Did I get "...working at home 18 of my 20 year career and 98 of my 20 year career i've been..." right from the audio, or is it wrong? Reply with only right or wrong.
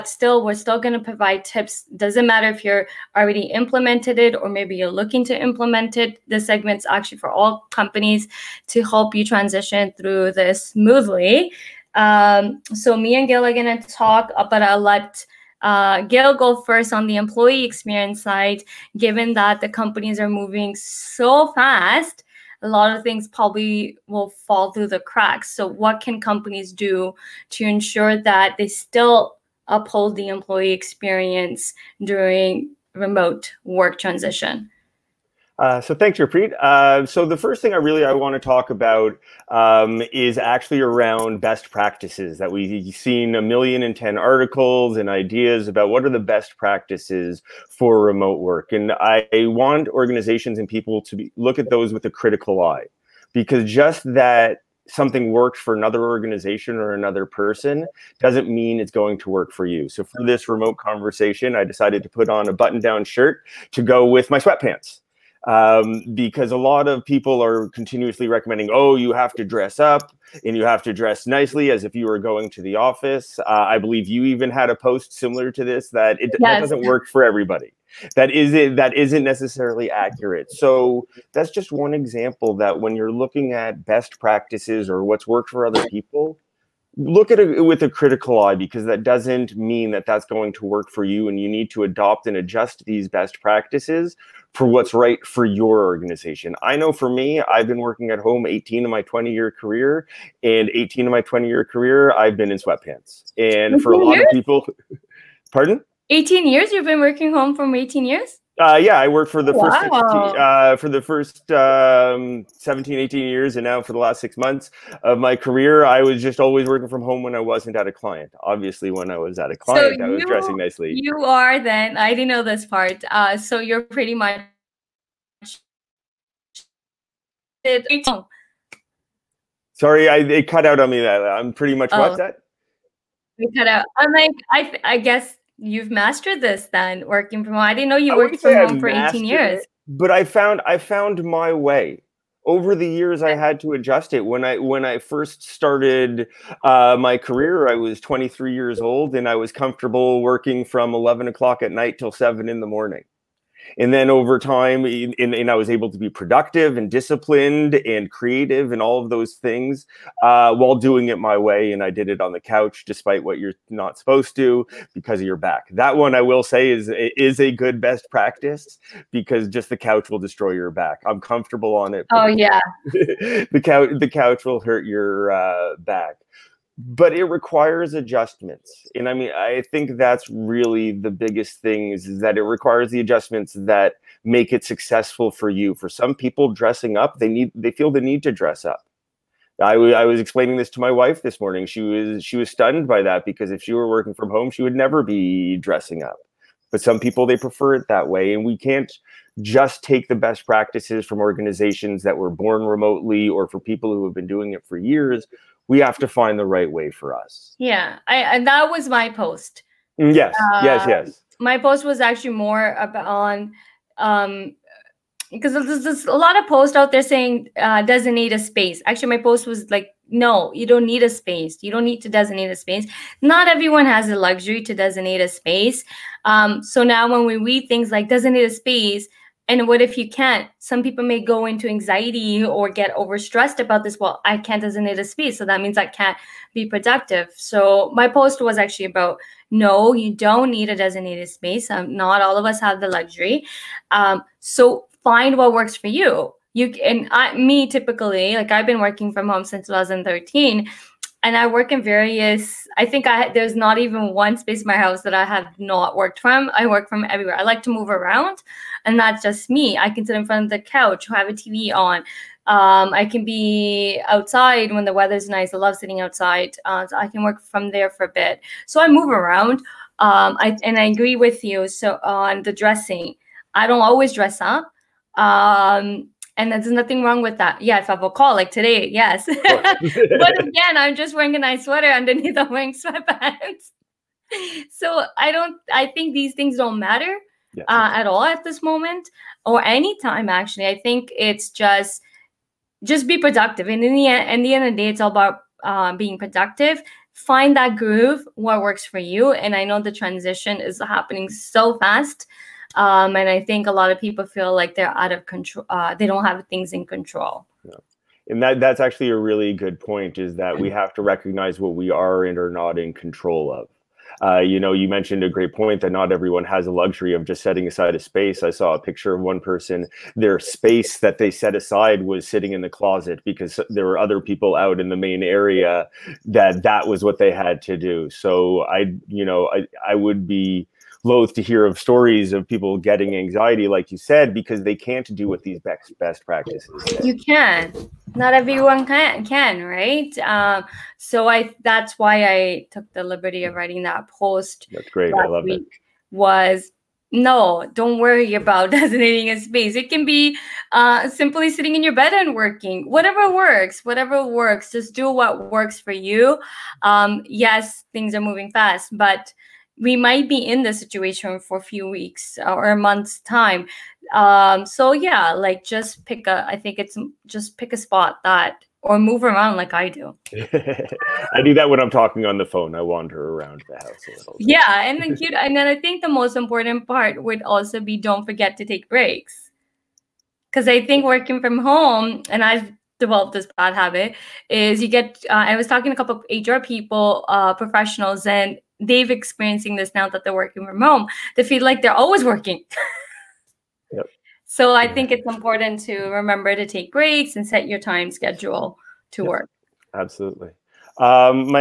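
wrong.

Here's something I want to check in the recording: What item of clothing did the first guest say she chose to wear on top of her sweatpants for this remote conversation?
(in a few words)
button-down shirt.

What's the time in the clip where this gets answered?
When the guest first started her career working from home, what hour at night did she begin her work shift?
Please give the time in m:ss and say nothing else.
2:30.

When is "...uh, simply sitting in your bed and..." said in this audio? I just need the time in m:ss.
5:50.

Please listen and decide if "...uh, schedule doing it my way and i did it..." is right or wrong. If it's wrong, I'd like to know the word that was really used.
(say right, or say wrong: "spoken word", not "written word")
wrong: "while", not "schedule".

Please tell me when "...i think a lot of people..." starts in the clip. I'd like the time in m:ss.
5:03.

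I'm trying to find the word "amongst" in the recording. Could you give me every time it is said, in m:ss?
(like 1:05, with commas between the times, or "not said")
not said.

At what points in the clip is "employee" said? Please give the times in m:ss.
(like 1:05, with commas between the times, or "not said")
0:17, 0:30.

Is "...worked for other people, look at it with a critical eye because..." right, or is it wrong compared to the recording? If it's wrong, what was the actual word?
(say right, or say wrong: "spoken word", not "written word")
right.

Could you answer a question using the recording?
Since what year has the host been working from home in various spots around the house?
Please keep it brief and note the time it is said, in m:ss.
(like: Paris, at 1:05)
2013, at 4:09.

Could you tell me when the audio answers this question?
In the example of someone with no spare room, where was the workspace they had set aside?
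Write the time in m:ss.
5:22.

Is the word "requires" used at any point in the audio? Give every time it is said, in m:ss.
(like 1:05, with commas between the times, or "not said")
2:57, 3:02.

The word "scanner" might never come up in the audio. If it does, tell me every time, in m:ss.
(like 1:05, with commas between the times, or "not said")
not said.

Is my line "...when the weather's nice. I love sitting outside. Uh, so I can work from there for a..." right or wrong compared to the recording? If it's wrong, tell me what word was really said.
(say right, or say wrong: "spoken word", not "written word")
right.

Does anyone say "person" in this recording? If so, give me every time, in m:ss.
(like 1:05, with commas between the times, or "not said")
0:57, 5:19.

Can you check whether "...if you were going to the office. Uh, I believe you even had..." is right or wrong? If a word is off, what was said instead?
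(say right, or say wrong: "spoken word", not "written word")
right.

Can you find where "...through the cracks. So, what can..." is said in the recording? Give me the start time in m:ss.
0:24.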